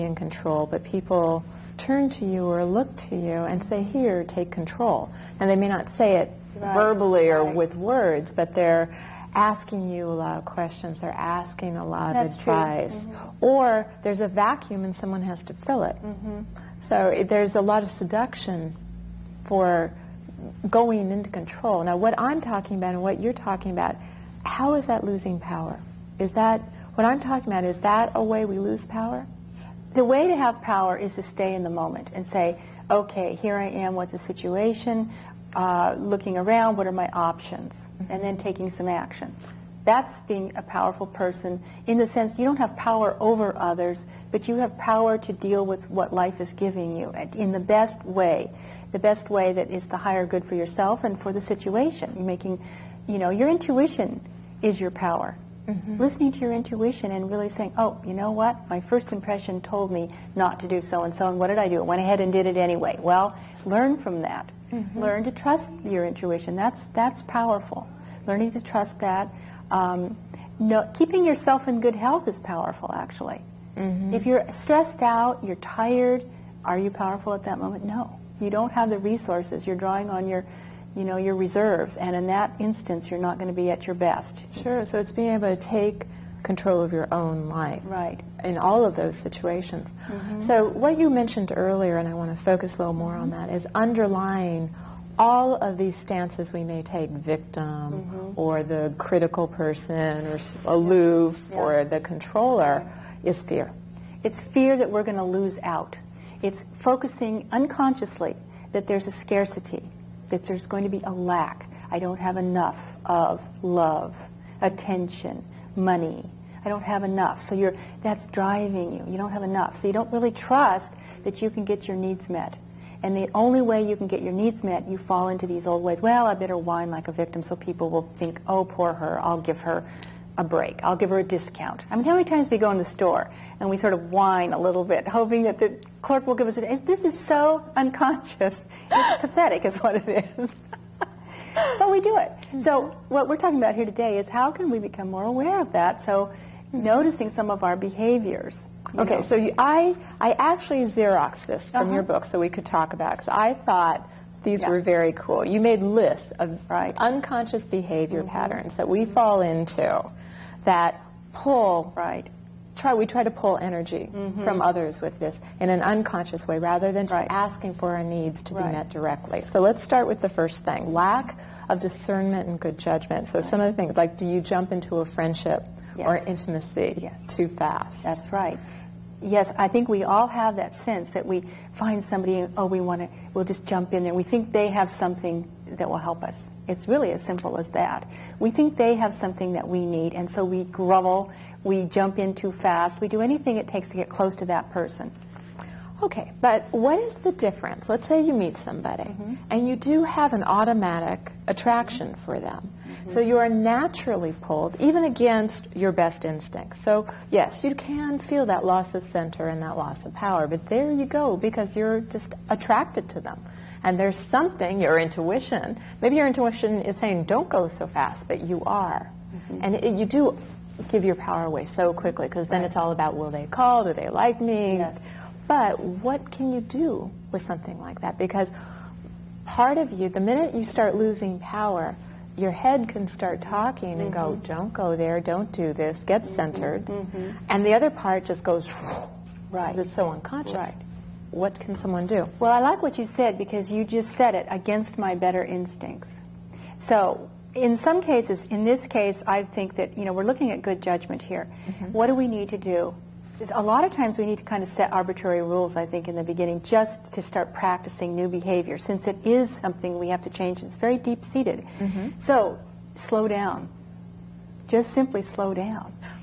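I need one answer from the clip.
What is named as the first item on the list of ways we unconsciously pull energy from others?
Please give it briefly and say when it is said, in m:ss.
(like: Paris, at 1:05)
Lack of discernment and good judgment, at 2:50.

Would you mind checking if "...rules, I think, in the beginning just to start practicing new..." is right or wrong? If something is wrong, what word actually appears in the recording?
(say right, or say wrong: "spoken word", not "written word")
right.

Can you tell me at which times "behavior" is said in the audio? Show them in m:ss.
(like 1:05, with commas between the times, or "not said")
2:27, 2:37, 4:18.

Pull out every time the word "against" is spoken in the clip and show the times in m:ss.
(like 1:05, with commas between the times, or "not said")
3:25, 4:04.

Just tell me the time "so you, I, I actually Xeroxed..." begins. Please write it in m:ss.
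2:29.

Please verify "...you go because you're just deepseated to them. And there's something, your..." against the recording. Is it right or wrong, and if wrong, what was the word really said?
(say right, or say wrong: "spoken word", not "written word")
wrong: "attracted", not "deepseated".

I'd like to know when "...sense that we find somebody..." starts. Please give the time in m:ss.
3:00.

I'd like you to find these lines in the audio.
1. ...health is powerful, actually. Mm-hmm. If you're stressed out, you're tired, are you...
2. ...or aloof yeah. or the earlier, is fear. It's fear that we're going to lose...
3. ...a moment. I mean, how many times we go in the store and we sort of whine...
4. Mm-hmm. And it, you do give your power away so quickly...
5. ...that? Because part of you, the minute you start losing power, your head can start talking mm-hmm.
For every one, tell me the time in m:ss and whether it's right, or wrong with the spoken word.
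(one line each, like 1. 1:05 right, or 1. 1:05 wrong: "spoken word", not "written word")
1. 1:11 right
2. 1:40 wrong: "controller", not "earlier"
3. 2:11 wrong: "discount", not "moment"
4. 3:39 right
5. 3:48 right.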